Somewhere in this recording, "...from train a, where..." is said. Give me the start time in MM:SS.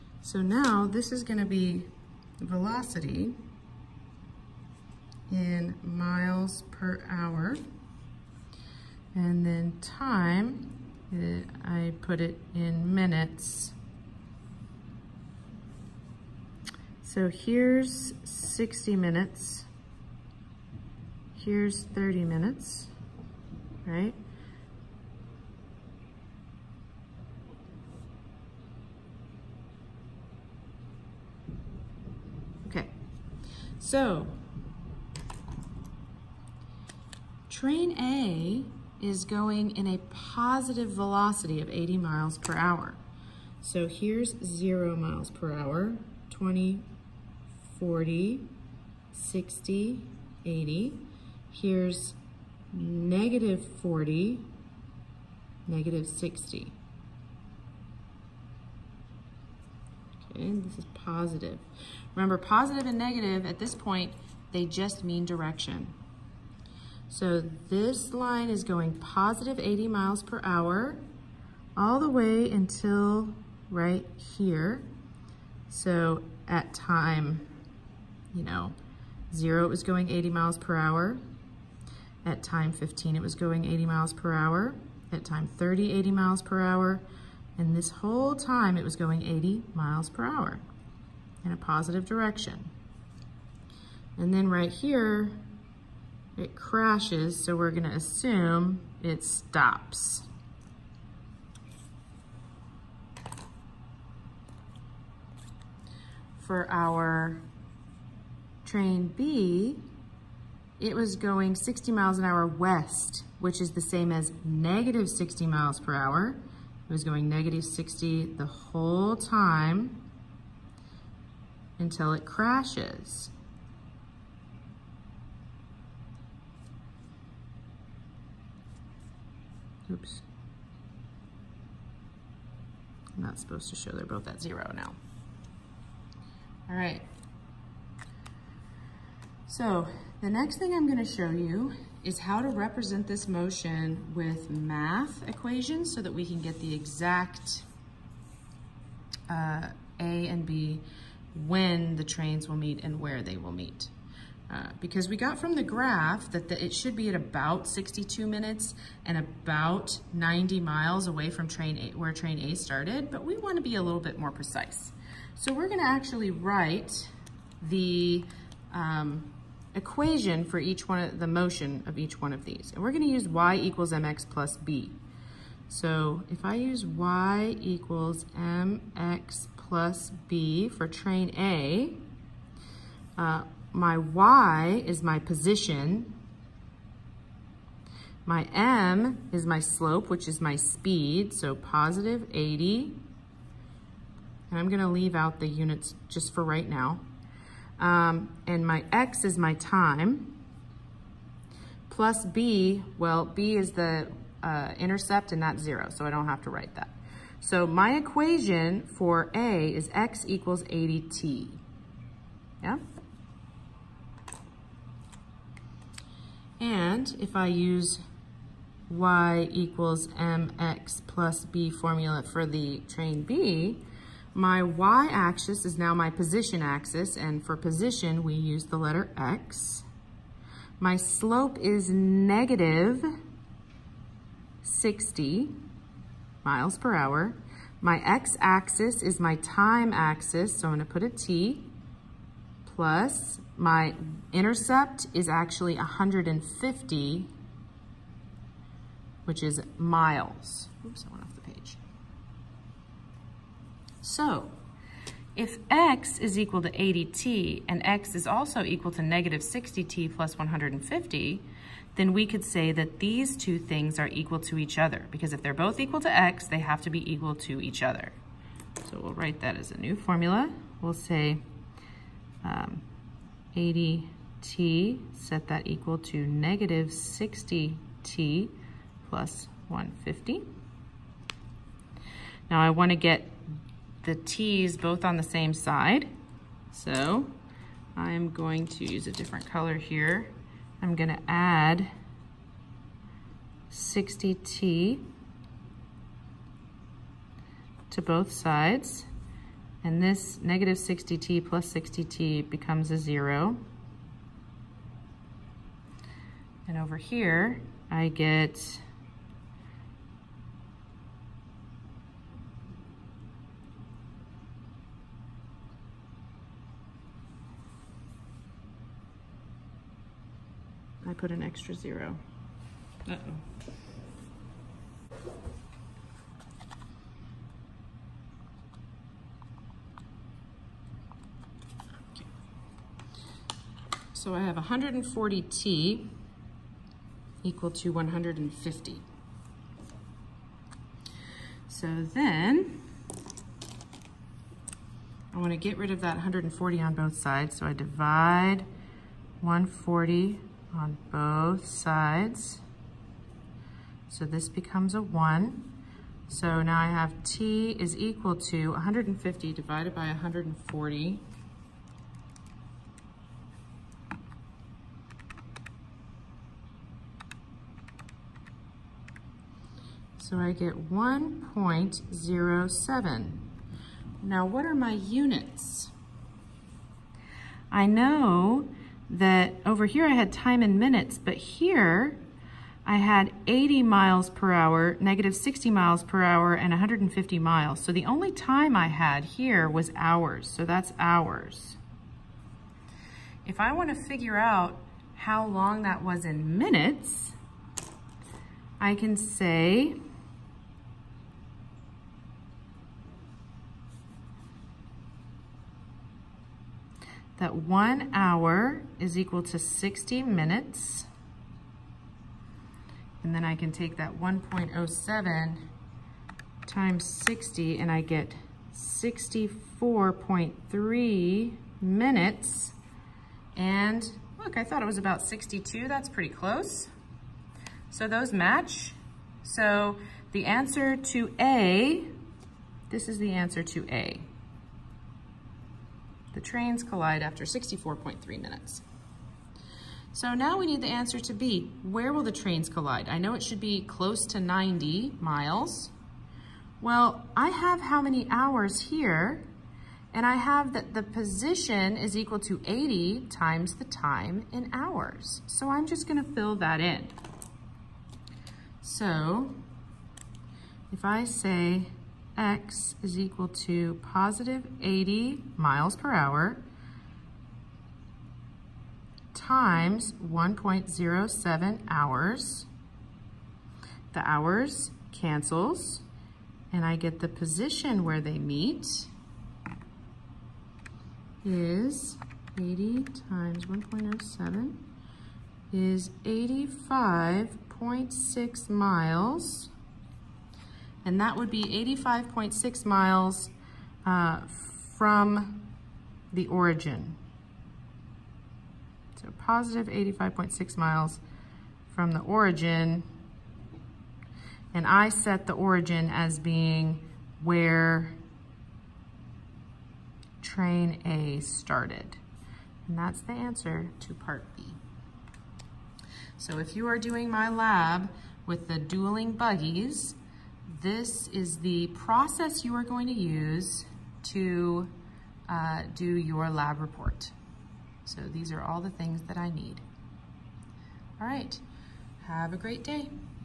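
02:41.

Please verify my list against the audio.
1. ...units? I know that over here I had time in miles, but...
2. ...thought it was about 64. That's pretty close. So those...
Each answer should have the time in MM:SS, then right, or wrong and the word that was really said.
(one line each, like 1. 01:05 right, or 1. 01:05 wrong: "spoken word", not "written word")
1. 06:14 wrong: "minutes", not "miles"
2. 07:04 wrong: "62", not "64".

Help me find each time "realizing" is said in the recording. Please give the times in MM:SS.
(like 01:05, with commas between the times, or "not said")
not said.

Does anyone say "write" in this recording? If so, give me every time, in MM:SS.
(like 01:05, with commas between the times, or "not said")
02:46, 03:26, 04:29.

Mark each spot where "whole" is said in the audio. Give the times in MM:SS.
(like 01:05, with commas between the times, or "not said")
01:27, 01:58.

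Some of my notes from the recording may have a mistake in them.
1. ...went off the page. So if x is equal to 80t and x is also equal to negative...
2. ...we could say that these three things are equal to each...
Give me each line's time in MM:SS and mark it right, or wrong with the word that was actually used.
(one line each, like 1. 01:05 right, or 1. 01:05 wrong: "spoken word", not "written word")
1. 04:11 right
2. 04:22 wrong: "two", not "three".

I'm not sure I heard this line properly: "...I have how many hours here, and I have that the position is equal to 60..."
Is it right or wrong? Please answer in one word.
wrong.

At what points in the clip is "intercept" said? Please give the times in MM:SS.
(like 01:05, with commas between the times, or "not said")
03:24, 04:04.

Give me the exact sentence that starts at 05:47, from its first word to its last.
So I divide 140 on both sides.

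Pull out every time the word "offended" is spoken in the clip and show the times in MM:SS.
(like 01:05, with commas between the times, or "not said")
not said.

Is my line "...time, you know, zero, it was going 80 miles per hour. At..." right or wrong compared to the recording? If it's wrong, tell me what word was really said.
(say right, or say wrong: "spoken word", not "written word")
right.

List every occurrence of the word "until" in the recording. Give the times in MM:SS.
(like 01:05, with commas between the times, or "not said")
01:12, 02:01.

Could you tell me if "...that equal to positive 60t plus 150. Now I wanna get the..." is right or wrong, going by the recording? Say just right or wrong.
wrong.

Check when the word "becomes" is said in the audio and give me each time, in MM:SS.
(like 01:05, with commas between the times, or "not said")
05:02, 05:54.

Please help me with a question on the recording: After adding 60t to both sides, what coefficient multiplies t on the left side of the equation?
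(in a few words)
140.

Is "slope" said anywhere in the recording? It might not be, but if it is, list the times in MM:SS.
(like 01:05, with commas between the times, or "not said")
03:09, 03:50.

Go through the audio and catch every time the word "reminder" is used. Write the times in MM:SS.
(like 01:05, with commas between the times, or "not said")
not said.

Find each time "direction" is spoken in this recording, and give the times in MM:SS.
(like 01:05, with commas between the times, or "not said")
01:05, 01:32.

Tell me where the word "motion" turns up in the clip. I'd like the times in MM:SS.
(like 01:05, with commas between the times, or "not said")
02:23, 02:51.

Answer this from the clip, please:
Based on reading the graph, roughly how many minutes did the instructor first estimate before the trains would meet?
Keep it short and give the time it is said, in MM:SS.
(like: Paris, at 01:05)
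62 minutes, at 02:37.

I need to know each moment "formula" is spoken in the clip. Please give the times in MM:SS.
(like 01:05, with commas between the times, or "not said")
03:41, 04:29.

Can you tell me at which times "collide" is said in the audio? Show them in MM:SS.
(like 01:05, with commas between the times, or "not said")
07:16, 07:22.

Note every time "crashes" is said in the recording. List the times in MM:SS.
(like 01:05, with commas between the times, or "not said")
01:36, 02:02.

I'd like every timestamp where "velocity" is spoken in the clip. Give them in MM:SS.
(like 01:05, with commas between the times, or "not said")
00:02, 00:40.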